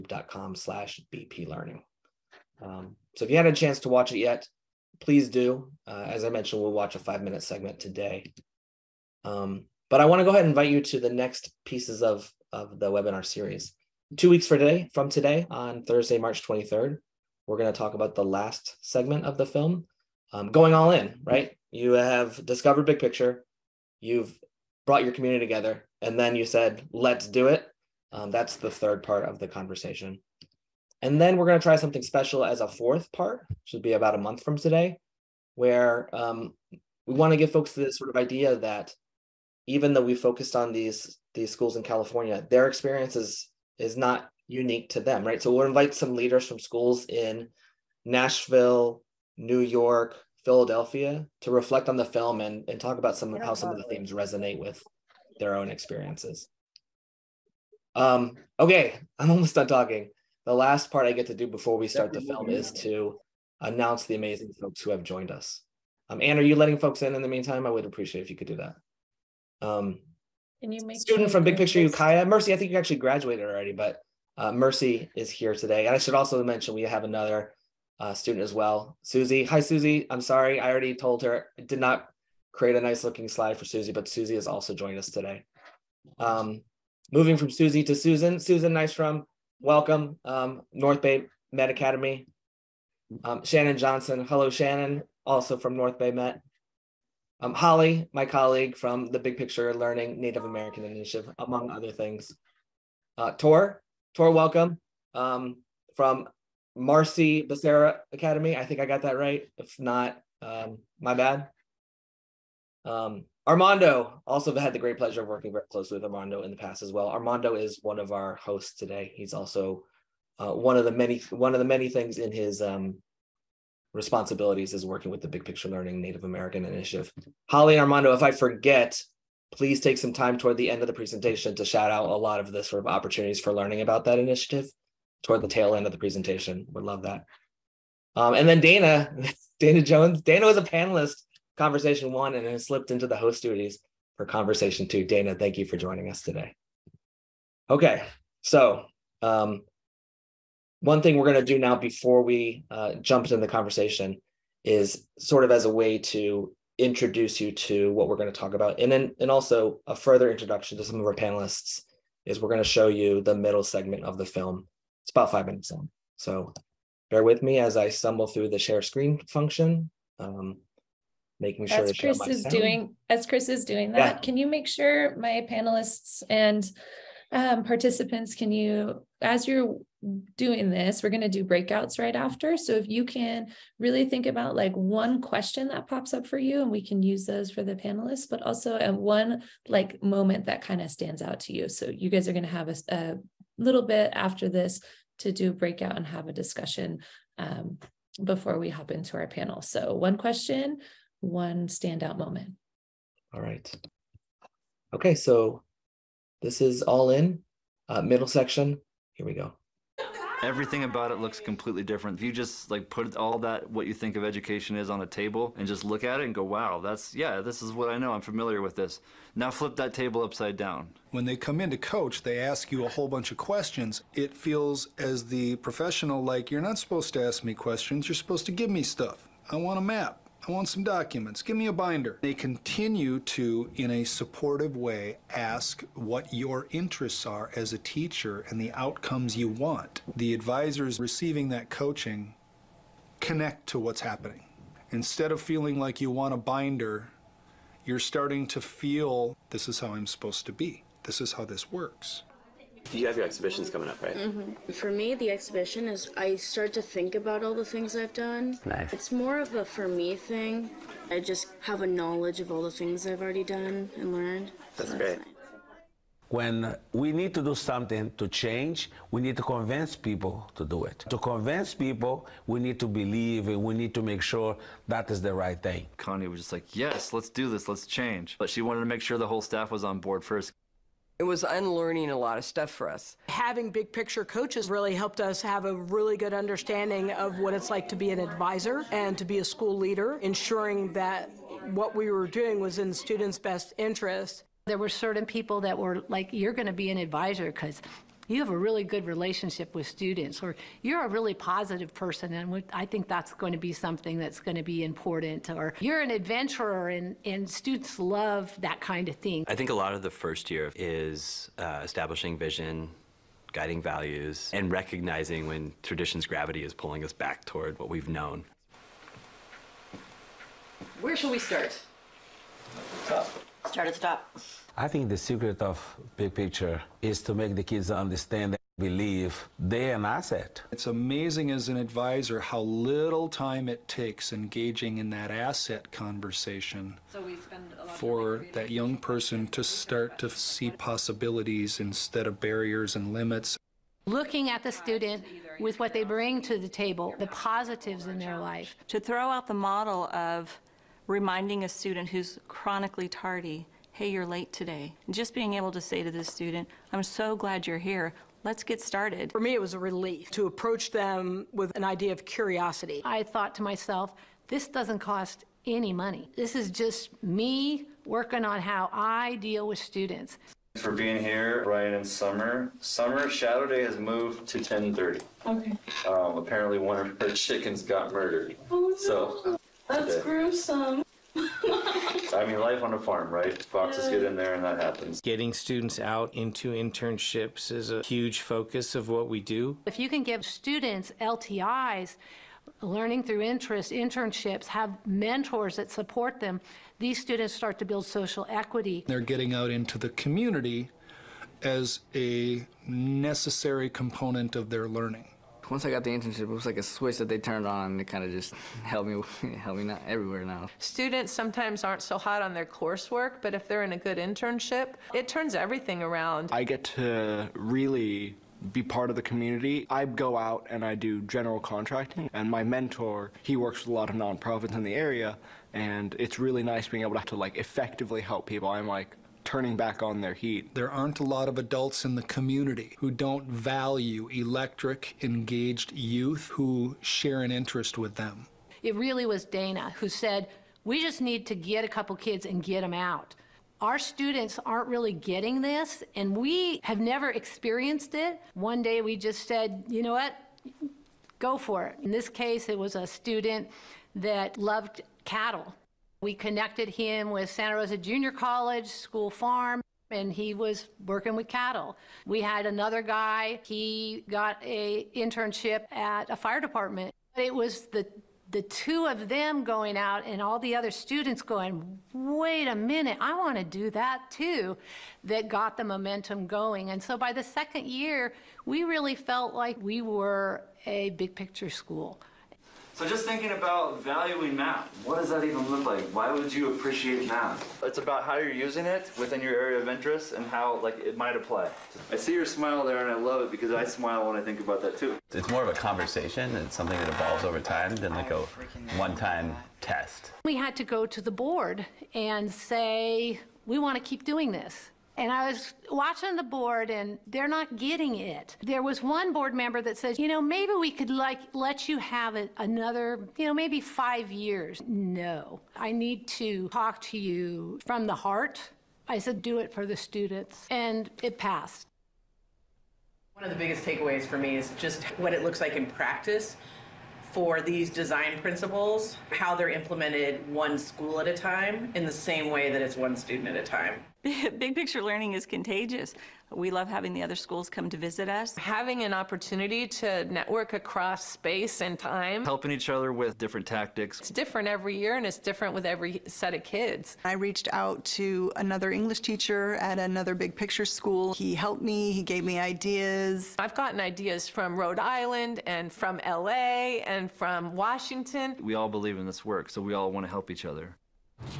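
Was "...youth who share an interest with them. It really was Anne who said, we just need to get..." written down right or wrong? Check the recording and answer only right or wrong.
wrong.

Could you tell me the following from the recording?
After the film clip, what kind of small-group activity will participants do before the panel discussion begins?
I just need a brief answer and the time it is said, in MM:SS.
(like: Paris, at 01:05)
Breakouts, at 03:01.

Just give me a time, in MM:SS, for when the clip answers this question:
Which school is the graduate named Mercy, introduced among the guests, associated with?
01:11.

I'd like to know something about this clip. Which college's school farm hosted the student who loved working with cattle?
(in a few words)
Santa Rosa Junior College.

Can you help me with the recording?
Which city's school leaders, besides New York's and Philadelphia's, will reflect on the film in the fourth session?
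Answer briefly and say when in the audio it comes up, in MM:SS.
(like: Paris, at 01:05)
Nashville, at 00:48.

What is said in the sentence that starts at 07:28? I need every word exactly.
One day we just said, you know what, go for it.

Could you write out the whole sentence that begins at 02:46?
So bear with me as I stumble through the share screen function.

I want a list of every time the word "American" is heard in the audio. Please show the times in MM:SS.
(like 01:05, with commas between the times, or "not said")
01:40, 02:06.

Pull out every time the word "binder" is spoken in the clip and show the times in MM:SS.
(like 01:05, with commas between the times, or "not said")
03:51, 04:06.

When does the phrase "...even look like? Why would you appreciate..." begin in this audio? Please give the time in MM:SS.
08:05.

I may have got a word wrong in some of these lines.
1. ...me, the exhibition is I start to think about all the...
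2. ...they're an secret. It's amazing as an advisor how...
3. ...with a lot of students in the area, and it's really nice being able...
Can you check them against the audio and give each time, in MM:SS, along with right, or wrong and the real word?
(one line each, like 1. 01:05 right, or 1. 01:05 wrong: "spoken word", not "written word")
1. 04:14 right
2. 05:29 wrong: "asset", not "secret"
3. 07:03 wrong: "nonprofits", not "students".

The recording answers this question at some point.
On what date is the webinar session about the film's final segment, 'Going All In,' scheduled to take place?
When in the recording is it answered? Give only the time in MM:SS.
00:15.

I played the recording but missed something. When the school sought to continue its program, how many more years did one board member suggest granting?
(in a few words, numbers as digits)
5.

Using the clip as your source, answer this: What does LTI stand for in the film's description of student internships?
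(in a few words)
Learning through interest.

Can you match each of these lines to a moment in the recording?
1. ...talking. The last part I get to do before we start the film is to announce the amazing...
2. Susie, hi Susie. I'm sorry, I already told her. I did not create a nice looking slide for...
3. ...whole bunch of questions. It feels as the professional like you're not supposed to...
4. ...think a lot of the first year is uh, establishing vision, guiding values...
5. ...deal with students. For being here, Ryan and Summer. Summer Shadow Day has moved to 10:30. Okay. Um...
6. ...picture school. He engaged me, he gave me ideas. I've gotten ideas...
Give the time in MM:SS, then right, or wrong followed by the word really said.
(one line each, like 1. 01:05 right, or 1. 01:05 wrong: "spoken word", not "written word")
1. 00:59 right
2. 01:19 right
3. 03:42 right
4. 05:09 right
5. 06:09 right
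6. 09:10 wrong: "helped", not "engaged".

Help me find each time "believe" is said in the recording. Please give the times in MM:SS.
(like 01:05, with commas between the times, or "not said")
04:32, 05:28, 09:18.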